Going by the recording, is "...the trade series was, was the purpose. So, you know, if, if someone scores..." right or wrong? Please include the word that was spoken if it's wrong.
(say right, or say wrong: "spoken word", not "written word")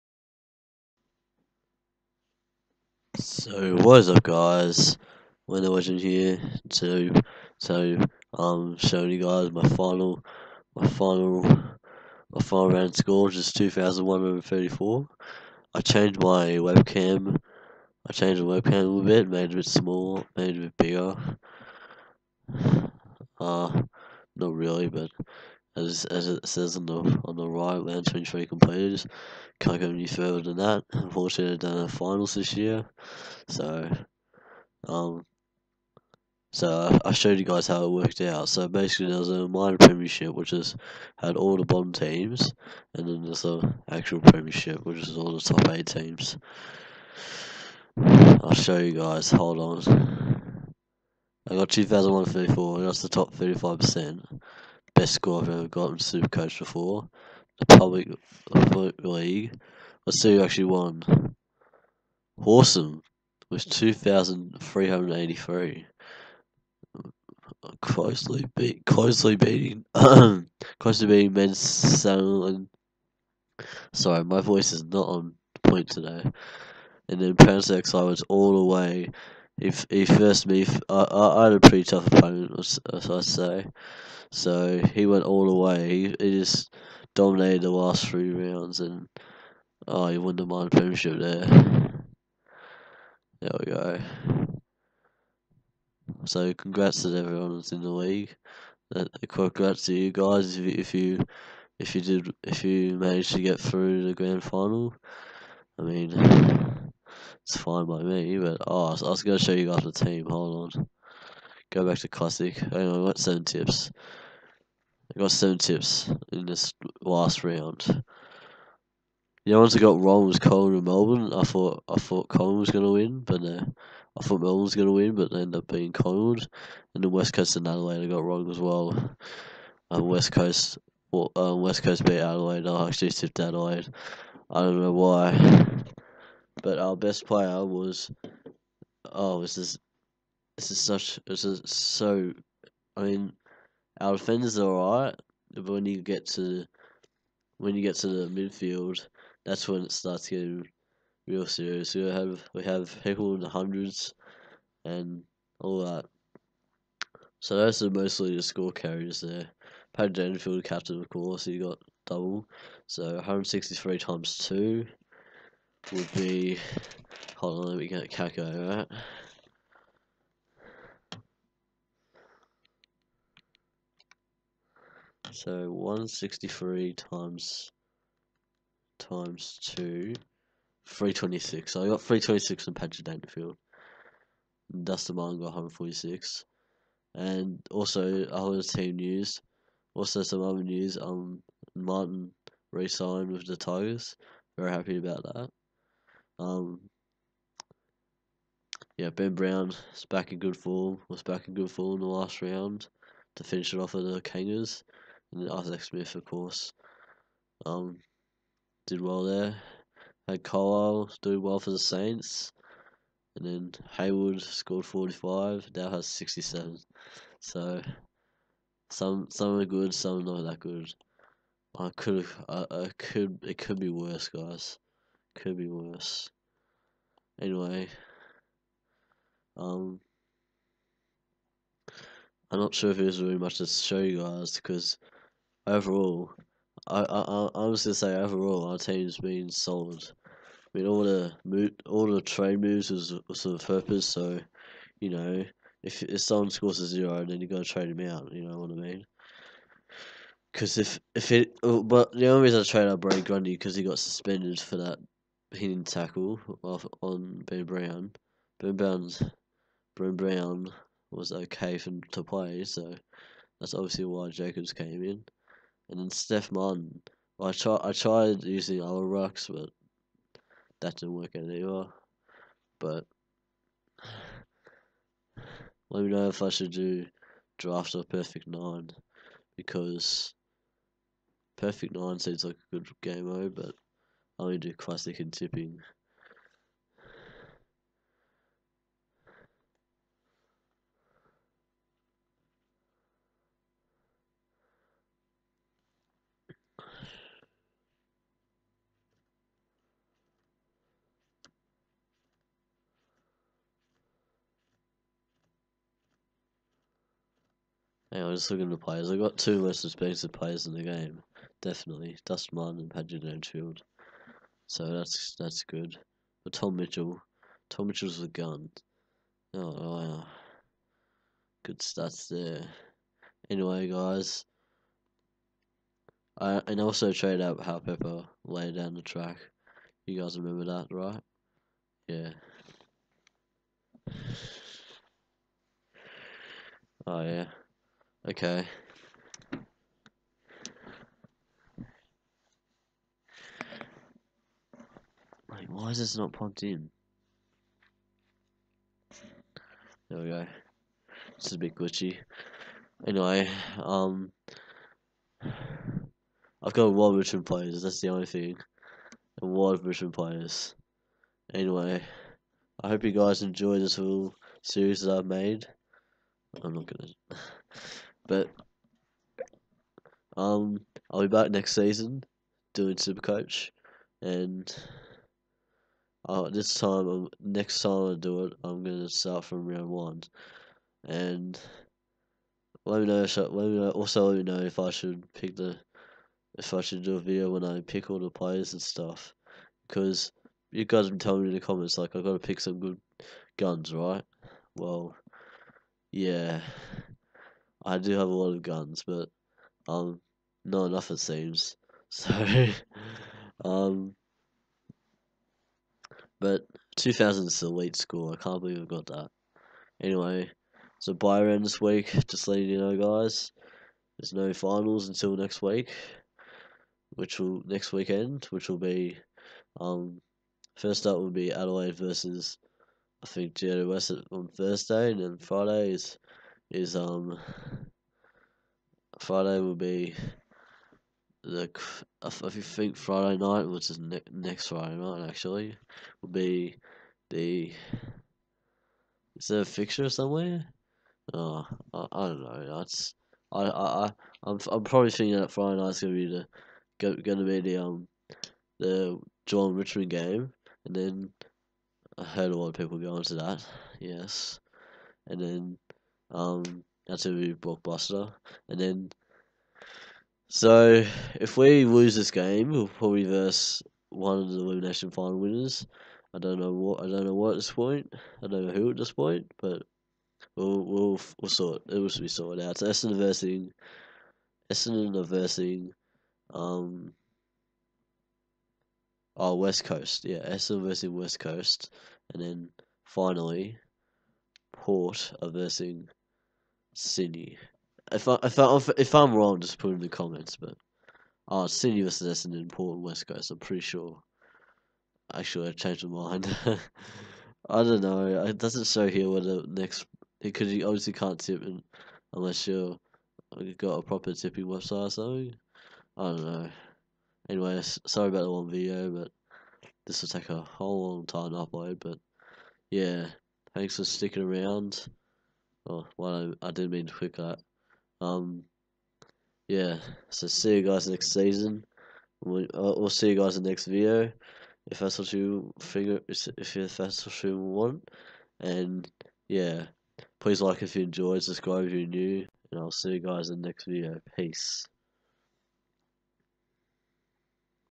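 wrong: "moves", not "series".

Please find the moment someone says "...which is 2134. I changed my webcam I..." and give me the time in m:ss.
0:13.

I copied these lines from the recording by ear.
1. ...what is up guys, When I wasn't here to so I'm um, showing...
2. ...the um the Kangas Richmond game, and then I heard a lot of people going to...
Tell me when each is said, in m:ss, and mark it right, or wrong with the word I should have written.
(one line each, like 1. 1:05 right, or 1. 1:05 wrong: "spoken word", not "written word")
1. 0:03 right
2. 7:27 wrong: "Geelong", not "Kangas".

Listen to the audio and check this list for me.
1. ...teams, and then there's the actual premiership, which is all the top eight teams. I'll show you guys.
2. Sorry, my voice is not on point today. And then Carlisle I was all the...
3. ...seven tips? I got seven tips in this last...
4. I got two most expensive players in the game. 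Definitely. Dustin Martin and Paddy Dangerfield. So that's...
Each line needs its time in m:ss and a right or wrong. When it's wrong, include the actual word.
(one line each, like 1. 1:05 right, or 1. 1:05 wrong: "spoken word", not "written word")
1. 0:41 right
2. 1:13 wrong: "Prince", not "Carlisle"
3. 1:53 right
4. 5:09 right.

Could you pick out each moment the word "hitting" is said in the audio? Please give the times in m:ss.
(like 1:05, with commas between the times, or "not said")
4:15.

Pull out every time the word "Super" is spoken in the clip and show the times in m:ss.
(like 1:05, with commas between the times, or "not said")
0:55, 6:12.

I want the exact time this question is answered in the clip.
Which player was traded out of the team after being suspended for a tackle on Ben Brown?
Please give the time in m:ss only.
4:12.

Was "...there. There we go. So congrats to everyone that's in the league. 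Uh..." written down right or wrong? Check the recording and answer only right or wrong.
right.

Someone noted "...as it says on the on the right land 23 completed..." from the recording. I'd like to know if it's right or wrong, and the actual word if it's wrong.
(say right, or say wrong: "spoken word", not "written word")
right.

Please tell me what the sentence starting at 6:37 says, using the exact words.
I do have a lot of guns, but um, not enough it seems.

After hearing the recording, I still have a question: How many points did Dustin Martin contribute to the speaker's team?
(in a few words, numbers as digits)
146.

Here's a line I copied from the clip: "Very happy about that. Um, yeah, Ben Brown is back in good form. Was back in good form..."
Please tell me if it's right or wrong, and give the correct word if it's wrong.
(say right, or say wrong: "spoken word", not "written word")
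right.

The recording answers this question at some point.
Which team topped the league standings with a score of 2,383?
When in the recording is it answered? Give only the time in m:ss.
1:02.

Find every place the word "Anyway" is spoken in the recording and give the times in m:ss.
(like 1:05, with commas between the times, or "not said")
1:52, 3:47, 5:23, 5:53, 6:01, 6:50, 8:27.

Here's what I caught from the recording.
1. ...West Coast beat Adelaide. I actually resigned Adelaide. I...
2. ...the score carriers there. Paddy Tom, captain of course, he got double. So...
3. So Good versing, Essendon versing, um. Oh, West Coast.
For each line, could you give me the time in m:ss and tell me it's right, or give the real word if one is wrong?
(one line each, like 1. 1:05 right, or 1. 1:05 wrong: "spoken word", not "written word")
1. 2:11 wrong: "tipped", not "resigned"
2. 2:38 wrong: "Dangerfield", not "Tom"
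3. 7:52 wrong: "Essendon", not "Good".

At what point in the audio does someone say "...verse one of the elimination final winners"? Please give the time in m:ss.
7:43.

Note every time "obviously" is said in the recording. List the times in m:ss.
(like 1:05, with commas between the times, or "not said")
4:23, 8:20.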